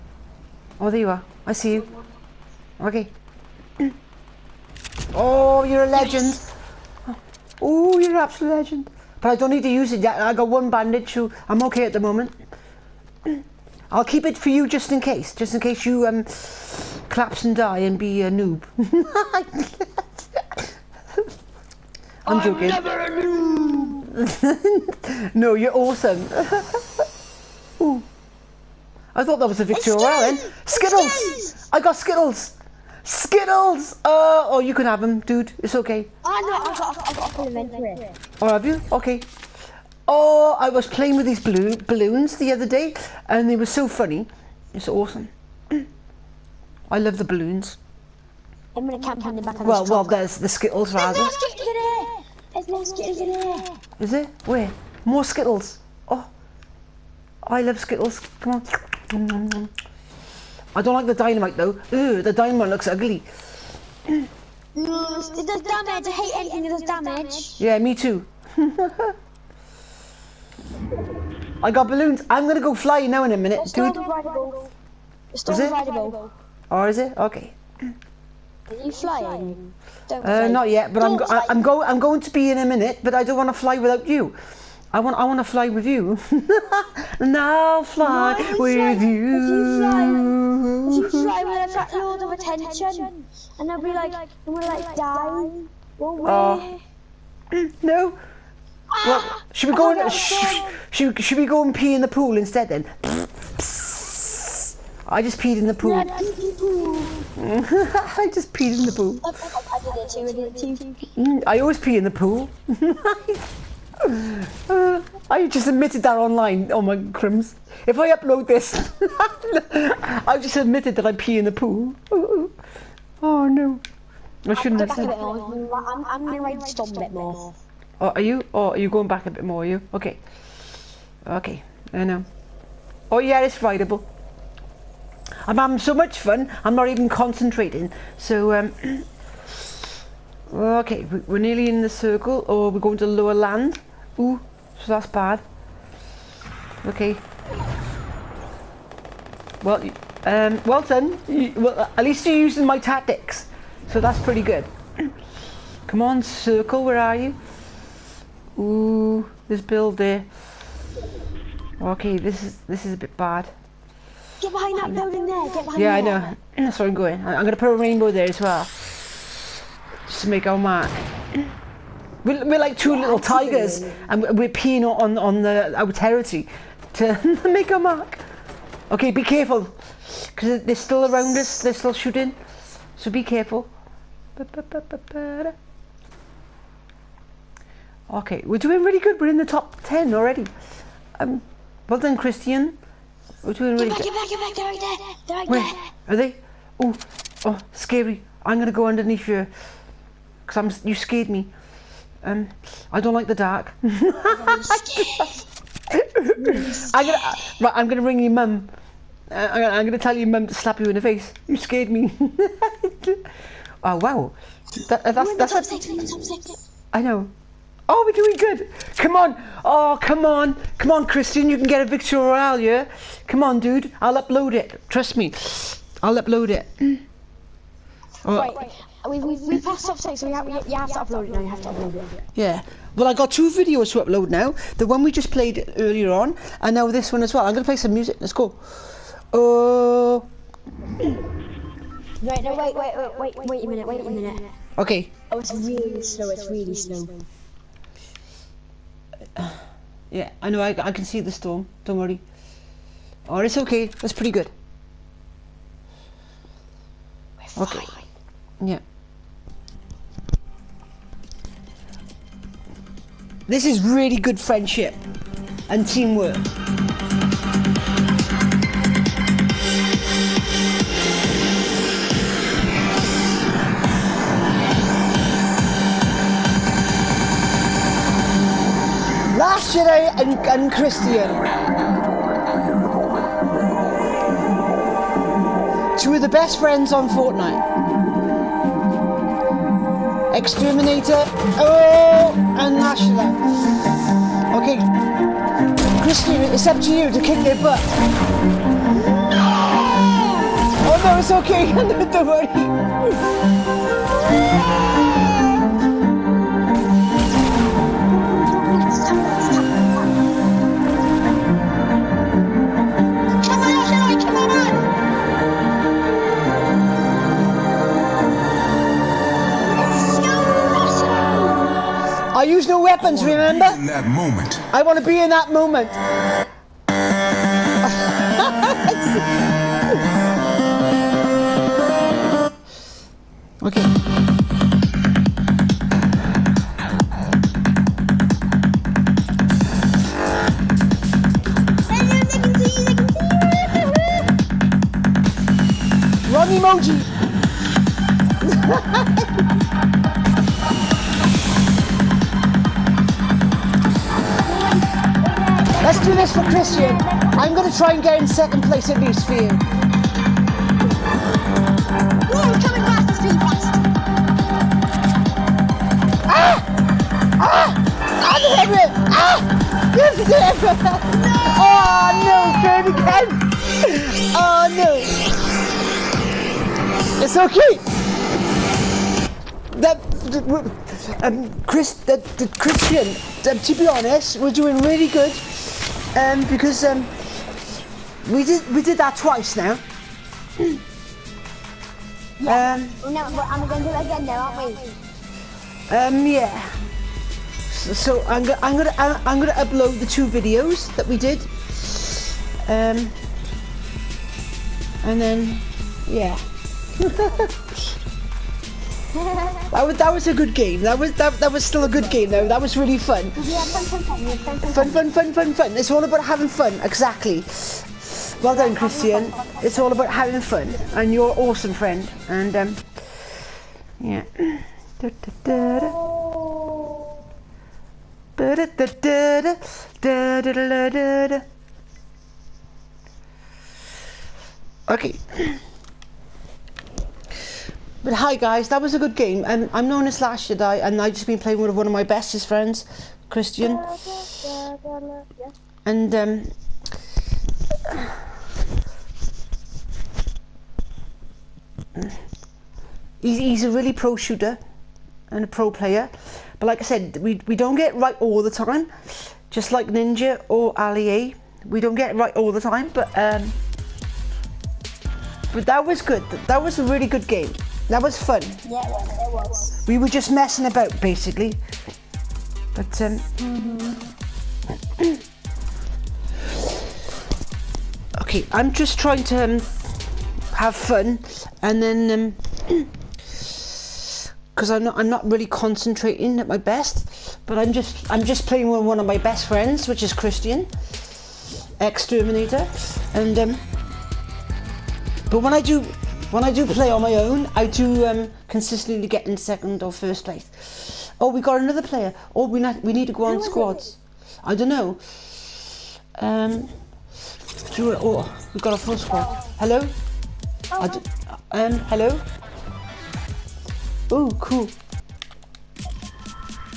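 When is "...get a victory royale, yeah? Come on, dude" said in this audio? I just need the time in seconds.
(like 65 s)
221 s.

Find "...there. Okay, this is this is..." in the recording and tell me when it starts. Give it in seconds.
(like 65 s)
159 s.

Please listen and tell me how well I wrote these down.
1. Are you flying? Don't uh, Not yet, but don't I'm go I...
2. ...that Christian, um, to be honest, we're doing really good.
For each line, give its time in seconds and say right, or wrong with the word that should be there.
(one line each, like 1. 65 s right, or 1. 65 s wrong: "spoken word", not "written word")
1. 77 s right
2. 382 s right.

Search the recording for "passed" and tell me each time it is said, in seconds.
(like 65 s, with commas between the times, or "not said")
229 s.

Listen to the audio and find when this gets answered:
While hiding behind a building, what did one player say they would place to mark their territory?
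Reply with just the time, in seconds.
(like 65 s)
167 s.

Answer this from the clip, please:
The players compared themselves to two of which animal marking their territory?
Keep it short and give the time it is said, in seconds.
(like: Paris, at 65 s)
tigers, at 173 s.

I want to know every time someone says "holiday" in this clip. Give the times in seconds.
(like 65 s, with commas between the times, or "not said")
not said.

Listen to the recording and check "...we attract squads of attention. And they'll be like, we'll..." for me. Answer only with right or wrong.
wrong.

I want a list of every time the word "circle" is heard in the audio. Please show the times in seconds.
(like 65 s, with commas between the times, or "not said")
141 s, 156 s.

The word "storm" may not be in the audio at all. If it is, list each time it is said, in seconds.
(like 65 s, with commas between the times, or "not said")
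251 s.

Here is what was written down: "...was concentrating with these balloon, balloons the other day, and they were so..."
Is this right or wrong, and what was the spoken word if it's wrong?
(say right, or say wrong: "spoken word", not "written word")
wrong: "playing", not "concentrating".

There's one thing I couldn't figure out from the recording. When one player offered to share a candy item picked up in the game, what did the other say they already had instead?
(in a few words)
elementary.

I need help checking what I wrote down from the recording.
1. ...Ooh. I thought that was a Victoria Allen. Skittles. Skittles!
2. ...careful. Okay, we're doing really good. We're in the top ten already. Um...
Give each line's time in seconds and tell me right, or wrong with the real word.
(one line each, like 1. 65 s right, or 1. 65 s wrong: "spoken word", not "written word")
1. 27 s right
2. 183 s right.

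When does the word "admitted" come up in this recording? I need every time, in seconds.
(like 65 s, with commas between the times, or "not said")
115 s, 120 s.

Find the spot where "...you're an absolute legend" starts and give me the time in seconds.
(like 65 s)
7 s.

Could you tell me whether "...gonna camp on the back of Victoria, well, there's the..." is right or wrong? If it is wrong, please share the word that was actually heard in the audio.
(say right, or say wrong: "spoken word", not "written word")
wrong: "Well", not "Victoria".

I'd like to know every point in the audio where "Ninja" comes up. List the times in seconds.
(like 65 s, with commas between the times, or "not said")
459 s.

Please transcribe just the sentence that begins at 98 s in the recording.
Ah, well, should we oh go and sh should, should we go and pee in the pool instead then?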